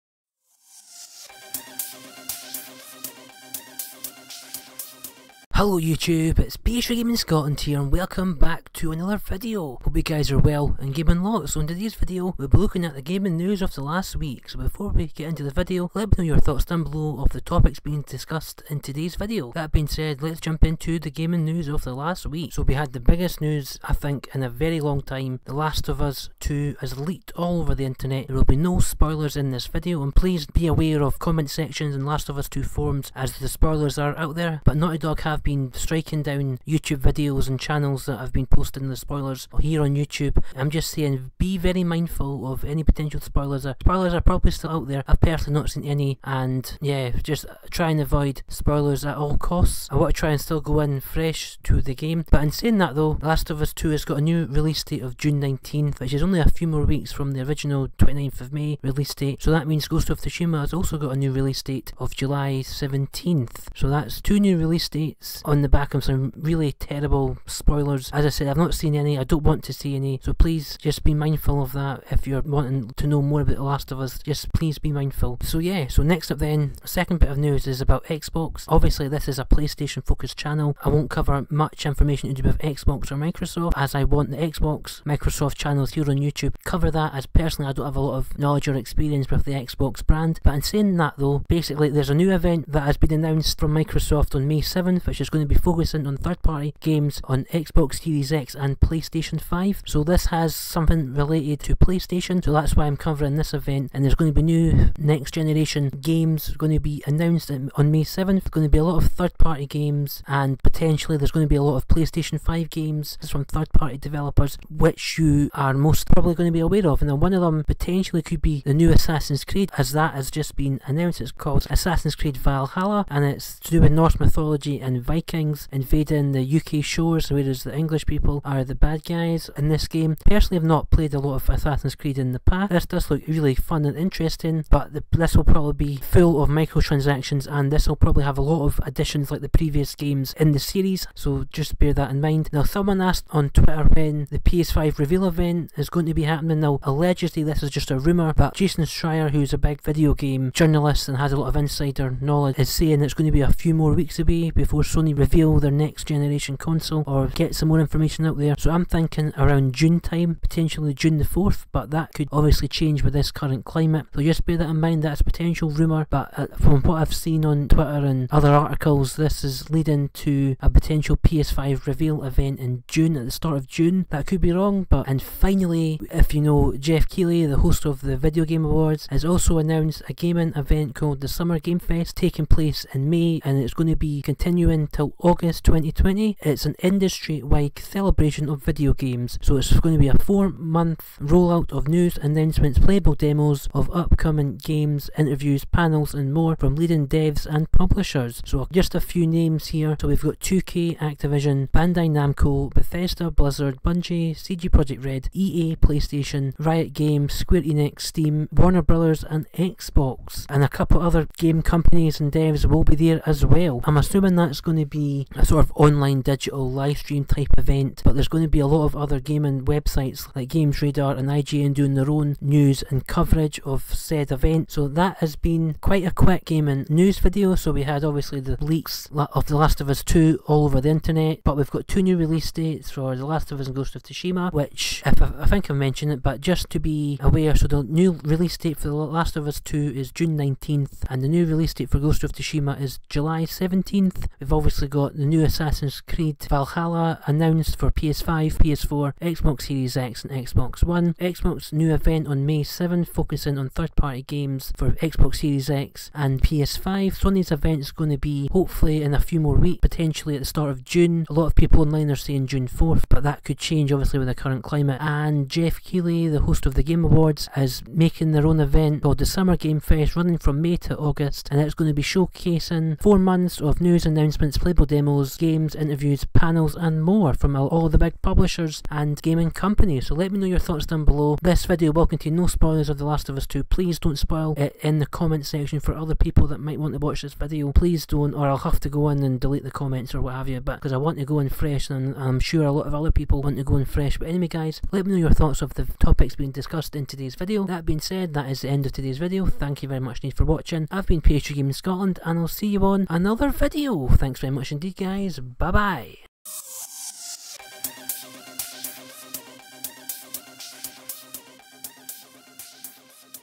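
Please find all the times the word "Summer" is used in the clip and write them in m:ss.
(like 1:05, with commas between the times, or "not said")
3:01, 4:29.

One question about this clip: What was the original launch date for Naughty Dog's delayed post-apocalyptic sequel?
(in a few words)
May 29.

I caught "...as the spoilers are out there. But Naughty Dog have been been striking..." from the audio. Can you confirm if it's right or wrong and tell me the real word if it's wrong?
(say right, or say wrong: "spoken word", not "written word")
right.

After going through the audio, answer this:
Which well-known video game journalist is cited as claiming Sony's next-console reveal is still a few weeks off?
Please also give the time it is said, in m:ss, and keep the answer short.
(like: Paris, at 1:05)
Jason Schreier, at 2:28.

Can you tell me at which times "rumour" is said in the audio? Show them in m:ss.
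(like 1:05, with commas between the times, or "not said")
2:27, 2:45.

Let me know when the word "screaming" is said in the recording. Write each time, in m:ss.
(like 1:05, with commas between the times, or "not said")
not said.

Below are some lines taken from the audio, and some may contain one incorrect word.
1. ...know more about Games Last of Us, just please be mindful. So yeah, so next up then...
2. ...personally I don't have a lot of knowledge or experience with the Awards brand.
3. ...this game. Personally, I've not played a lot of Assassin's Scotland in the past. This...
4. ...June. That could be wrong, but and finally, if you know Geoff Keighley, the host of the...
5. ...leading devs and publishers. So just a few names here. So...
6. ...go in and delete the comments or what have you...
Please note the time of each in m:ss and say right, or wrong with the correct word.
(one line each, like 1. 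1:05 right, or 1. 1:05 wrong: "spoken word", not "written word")
1. 1:13 wrong: "The", not "Games"
2. 1:27 wrong: "Xbox", not "Awards"
3. 2:09 wrong: "Creed", not "Scotland"
4. 2:53 right
5. 3:16 right
6. 4:48 right.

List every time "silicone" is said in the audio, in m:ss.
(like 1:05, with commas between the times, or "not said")
not said.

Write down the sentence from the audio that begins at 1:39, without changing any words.
So this has something related to PlayStation, so that's why I'm covering this event.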